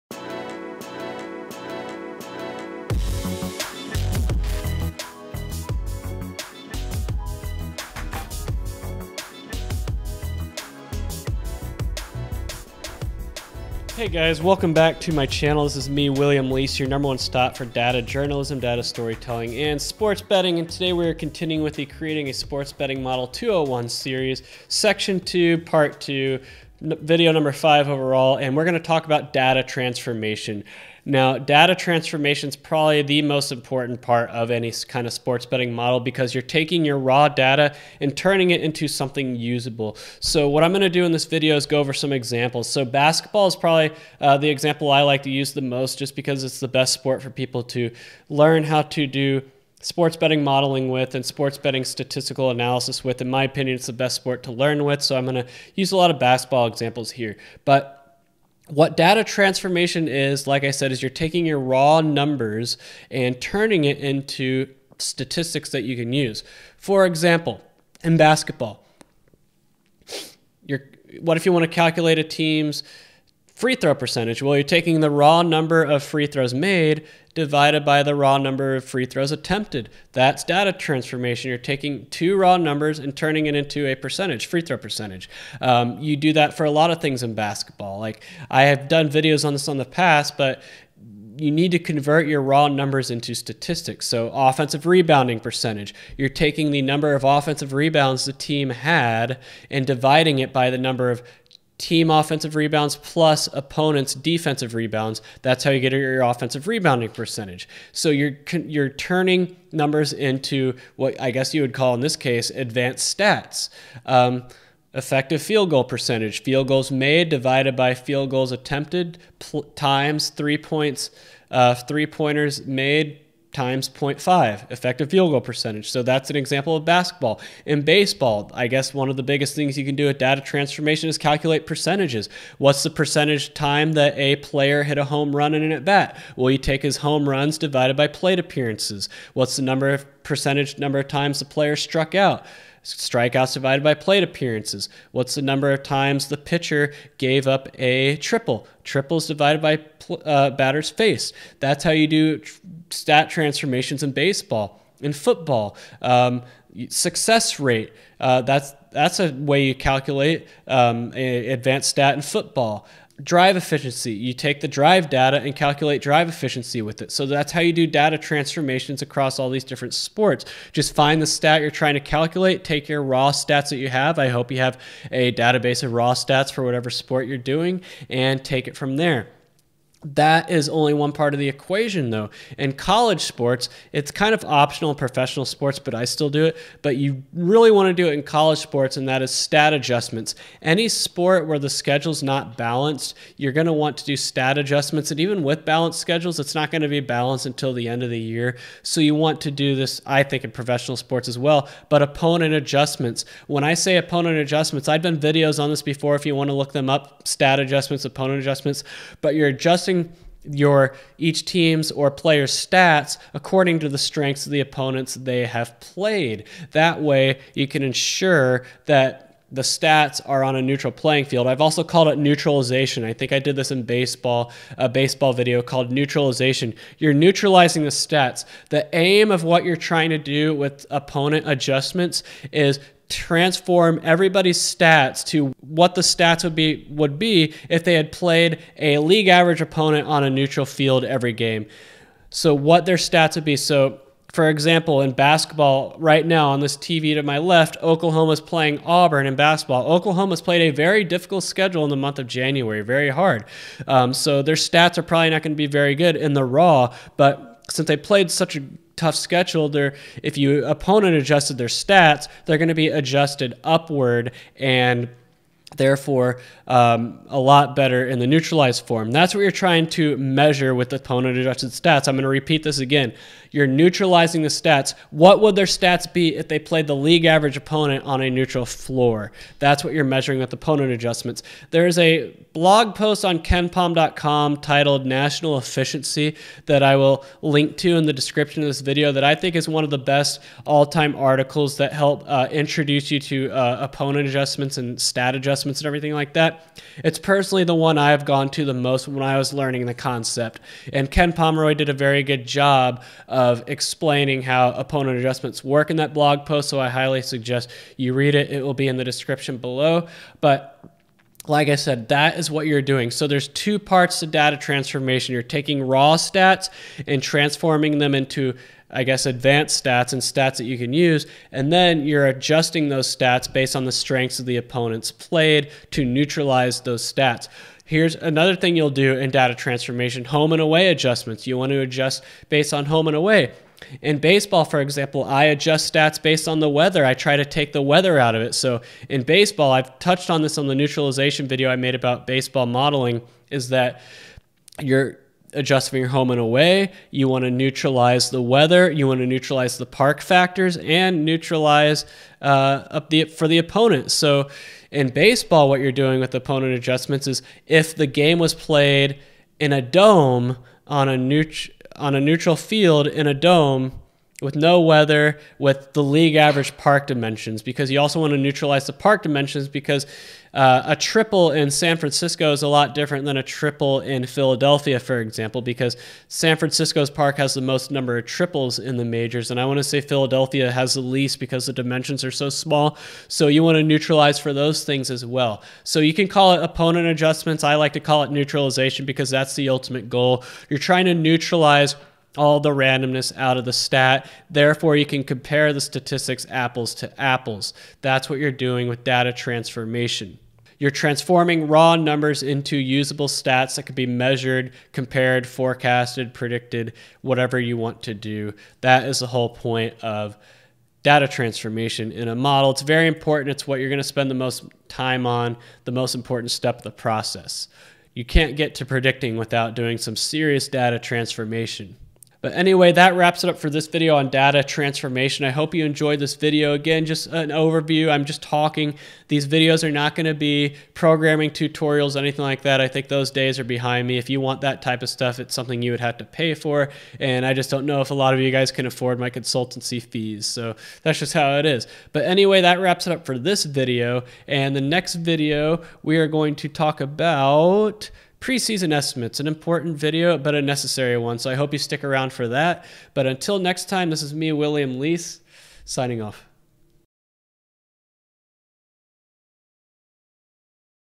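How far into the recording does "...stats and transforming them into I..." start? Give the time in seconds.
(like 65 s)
316 s.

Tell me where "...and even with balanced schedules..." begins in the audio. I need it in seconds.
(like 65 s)
195 s.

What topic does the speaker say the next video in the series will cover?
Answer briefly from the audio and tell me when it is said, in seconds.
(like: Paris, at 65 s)
Preseason estimates, at 448 s.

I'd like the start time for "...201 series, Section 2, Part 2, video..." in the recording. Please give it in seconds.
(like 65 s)
23 s.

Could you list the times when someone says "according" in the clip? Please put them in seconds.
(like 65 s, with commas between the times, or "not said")
213 s.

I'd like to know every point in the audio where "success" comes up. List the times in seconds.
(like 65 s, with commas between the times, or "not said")
156 s.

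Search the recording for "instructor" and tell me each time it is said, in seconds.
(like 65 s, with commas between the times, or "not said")
not said.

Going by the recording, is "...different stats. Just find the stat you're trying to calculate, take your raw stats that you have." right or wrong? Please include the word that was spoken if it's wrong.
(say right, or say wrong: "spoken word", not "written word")
wrong: "sports", not "stats".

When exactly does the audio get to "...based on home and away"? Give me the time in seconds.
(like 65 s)
332 s.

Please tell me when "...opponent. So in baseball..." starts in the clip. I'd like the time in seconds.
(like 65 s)
353 s.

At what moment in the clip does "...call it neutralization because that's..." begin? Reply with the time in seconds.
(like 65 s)
388 s.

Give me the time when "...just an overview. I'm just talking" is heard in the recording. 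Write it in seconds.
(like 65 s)
427 s.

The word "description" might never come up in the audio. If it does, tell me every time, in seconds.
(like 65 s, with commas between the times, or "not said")
288 s, 309 s.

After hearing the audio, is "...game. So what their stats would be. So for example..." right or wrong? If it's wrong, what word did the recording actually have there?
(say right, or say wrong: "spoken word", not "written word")
right.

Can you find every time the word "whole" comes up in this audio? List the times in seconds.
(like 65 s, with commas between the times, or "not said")
409 s.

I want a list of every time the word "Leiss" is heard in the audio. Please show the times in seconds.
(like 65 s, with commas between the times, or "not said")
16 s, 454 s.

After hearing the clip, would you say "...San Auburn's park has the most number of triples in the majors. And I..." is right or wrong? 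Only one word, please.
wrong.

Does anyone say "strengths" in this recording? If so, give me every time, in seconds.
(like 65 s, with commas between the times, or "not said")
213 s, 323 s.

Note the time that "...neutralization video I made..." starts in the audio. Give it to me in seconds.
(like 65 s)
340 s.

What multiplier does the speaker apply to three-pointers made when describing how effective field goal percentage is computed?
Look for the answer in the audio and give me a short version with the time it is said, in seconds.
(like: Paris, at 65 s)
0.5, at 123 s.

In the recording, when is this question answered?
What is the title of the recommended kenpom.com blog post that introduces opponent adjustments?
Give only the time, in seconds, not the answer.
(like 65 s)
285 s.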